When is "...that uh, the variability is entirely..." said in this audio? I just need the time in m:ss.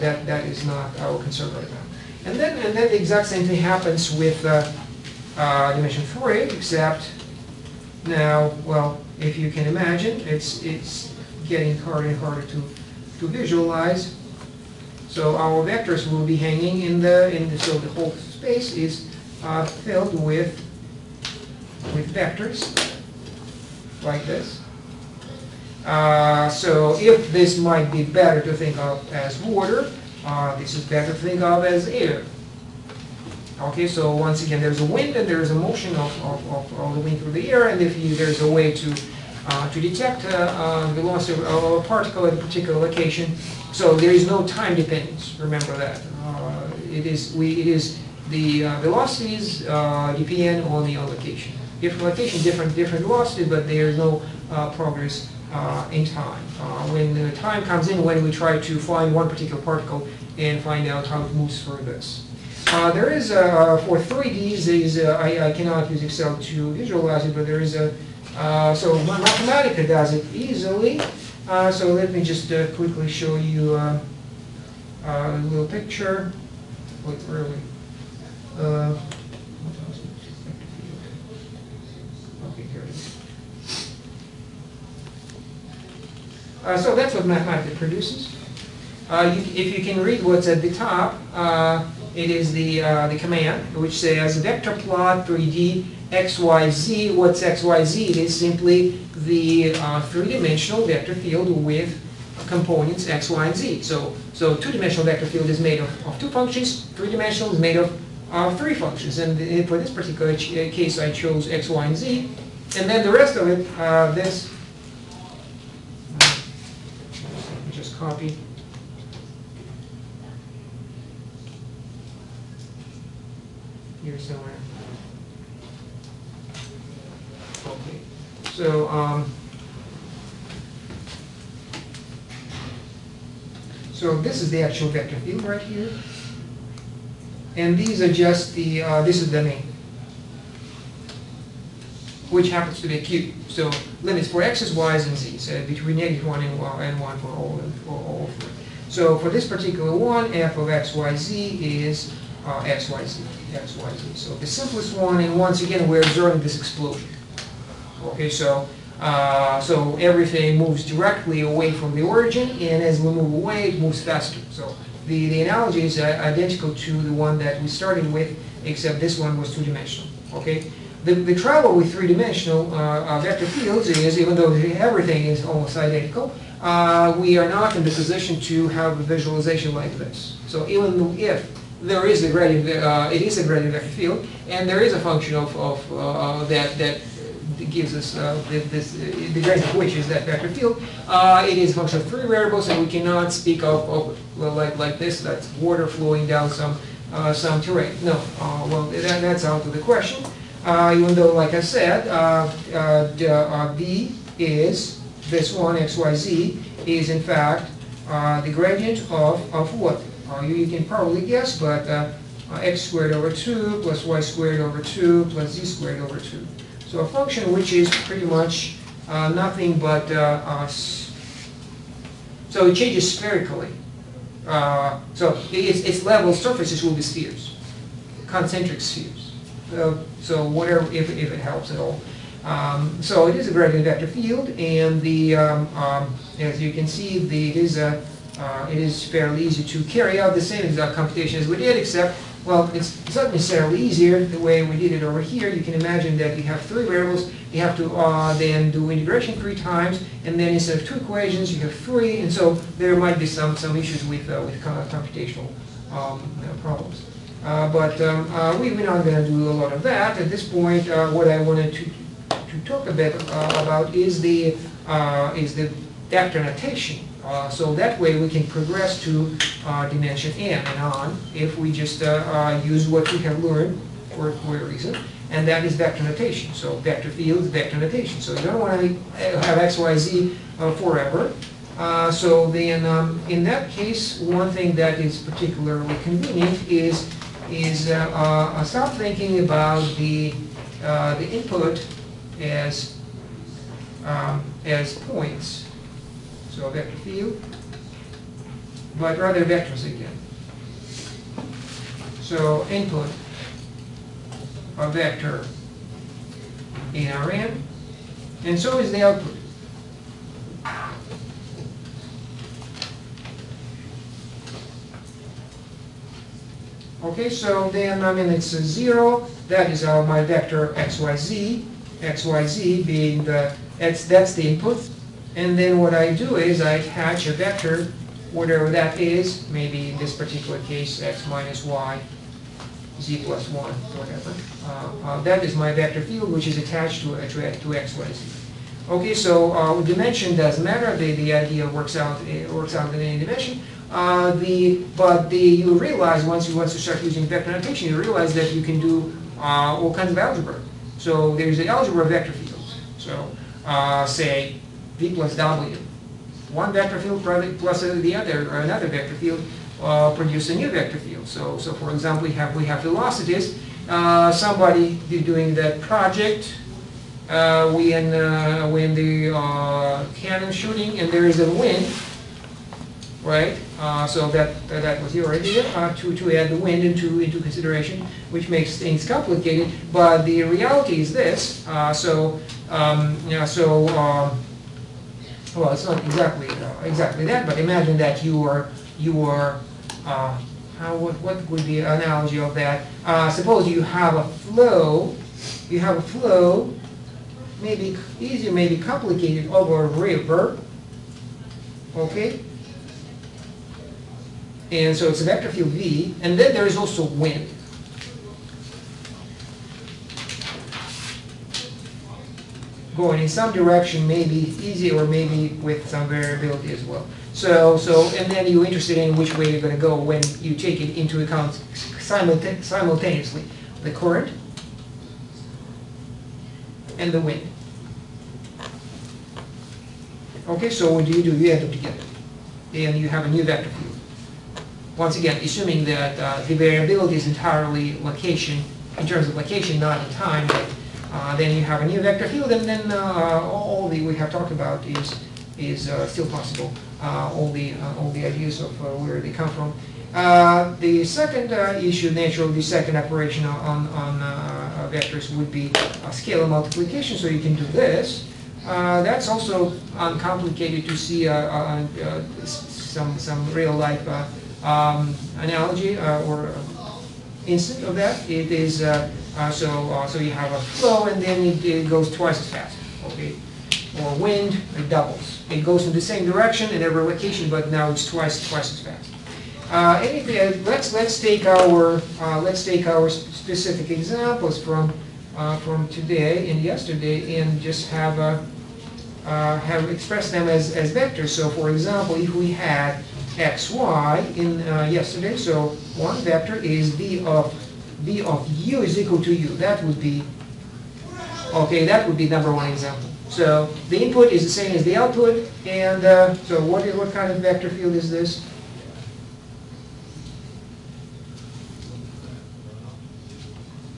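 7:15.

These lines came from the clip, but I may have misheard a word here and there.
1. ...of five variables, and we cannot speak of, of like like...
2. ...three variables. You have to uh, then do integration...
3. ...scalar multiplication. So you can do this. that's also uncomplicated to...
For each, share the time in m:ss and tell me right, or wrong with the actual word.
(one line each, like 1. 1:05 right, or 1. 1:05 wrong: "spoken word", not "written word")
1. 3:11 wrong: "three", not "five"
2. 4:06 right
3. 7:36 right.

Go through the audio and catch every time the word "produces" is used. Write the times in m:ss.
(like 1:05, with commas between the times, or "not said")
1:27, 6:00.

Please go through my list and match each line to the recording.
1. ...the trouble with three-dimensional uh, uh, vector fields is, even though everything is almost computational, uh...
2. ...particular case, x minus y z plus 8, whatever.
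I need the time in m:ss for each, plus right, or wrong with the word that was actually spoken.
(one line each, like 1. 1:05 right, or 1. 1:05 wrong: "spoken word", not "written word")
1. 2:51 wrong: "identical", not "computational"
2. 5:30 wrong: "1", not "8".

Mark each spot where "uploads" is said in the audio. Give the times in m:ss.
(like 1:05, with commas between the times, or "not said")
not said.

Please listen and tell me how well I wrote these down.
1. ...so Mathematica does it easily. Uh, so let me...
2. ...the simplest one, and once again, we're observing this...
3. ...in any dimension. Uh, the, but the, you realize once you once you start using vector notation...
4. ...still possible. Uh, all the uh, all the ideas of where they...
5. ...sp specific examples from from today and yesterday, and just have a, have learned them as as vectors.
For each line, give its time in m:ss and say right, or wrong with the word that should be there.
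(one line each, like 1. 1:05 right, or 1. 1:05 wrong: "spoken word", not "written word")
1. 1:08 right
2. 2:34 right
3. 5:42 right
4. 7:26 right
5. 8:03 wrong: "expressed", not "learned".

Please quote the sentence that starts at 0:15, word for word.
So our vectors will be hanging in the, in the so the whole space is uh, filled with, with vectors like this.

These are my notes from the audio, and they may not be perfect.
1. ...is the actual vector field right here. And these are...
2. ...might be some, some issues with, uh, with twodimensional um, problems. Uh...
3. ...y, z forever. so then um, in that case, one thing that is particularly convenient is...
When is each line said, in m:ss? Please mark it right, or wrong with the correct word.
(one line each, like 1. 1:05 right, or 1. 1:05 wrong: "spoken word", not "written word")
1. 2:14 right
2. 4:12 wrong: "computational", not "twodimensional"
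3. 4:39 right.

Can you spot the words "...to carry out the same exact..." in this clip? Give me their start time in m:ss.
3:59.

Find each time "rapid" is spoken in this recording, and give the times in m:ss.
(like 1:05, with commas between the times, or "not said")
not said.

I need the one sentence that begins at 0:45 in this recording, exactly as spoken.
Remember that uh, it is we it is the velocities depend on the location.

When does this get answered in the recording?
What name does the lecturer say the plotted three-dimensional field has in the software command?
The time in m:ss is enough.
2:22.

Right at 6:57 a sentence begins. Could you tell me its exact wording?
So, so, and then you're interested in which way you're going to go when you take it into account simultaneously.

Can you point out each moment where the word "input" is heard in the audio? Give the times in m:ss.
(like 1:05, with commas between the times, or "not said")
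4:51, 5:02, 5:24, 8:24.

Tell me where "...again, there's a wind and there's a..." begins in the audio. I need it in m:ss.
0:34.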